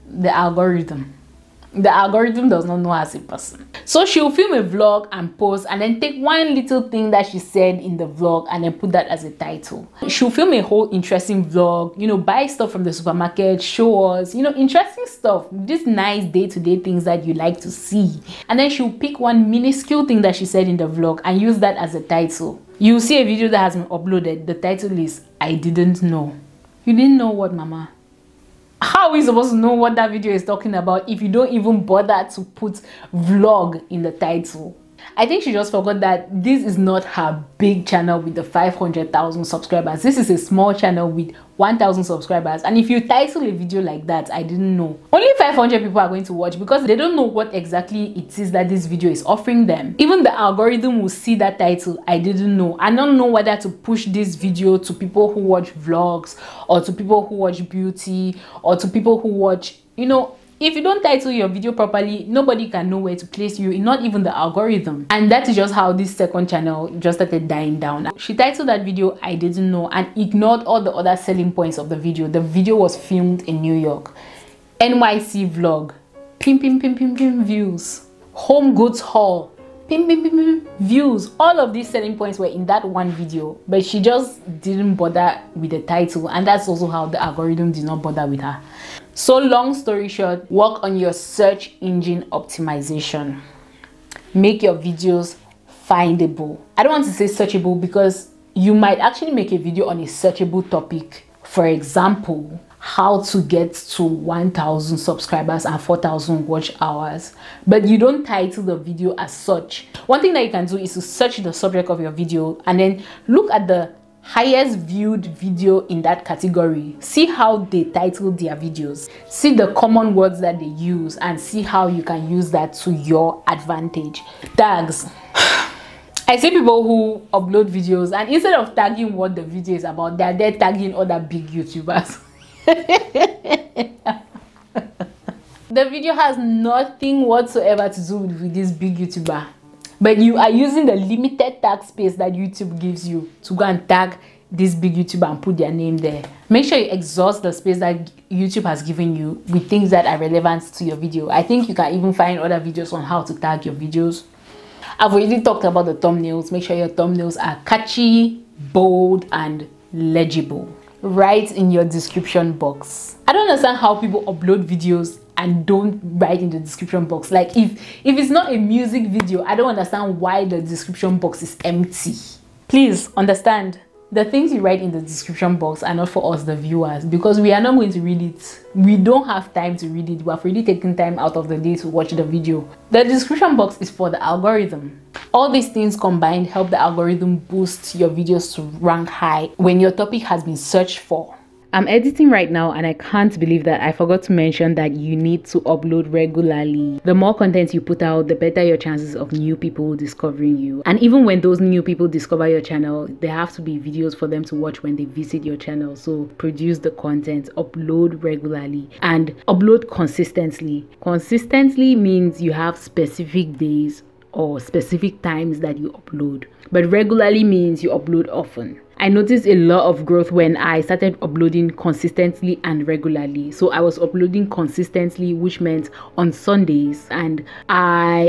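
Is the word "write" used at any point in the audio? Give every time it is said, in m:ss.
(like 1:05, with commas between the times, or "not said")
2:46, 2:54.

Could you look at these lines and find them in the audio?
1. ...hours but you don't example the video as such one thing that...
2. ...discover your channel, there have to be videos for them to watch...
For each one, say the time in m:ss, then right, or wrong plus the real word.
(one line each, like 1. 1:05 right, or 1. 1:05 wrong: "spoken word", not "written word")
1. 1:46 wrong: "title", not "example"
2. 3:22 right.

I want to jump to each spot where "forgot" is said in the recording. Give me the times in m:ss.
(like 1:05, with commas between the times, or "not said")
0:35, 3:13.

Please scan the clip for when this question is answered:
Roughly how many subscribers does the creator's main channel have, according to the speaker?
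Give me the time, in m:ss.
0:38.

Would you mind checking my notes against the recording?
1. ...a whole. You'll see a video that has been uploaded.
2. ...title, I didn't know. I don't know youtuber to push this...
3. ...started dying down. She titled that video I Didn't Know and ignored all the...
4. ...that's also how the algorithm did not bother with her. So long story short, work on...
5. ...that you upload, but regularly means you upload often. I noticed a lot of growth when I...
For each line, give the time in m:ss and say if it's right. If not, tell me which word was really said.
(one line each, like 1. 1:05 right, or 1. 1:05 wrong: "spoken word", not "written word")
1. 0:21 wrong: "title", not "whole"
2. 0:51 wrong: "whether", not "youtuber"
3. 1:07 right
4. 1:26 right
5. 3:35 right.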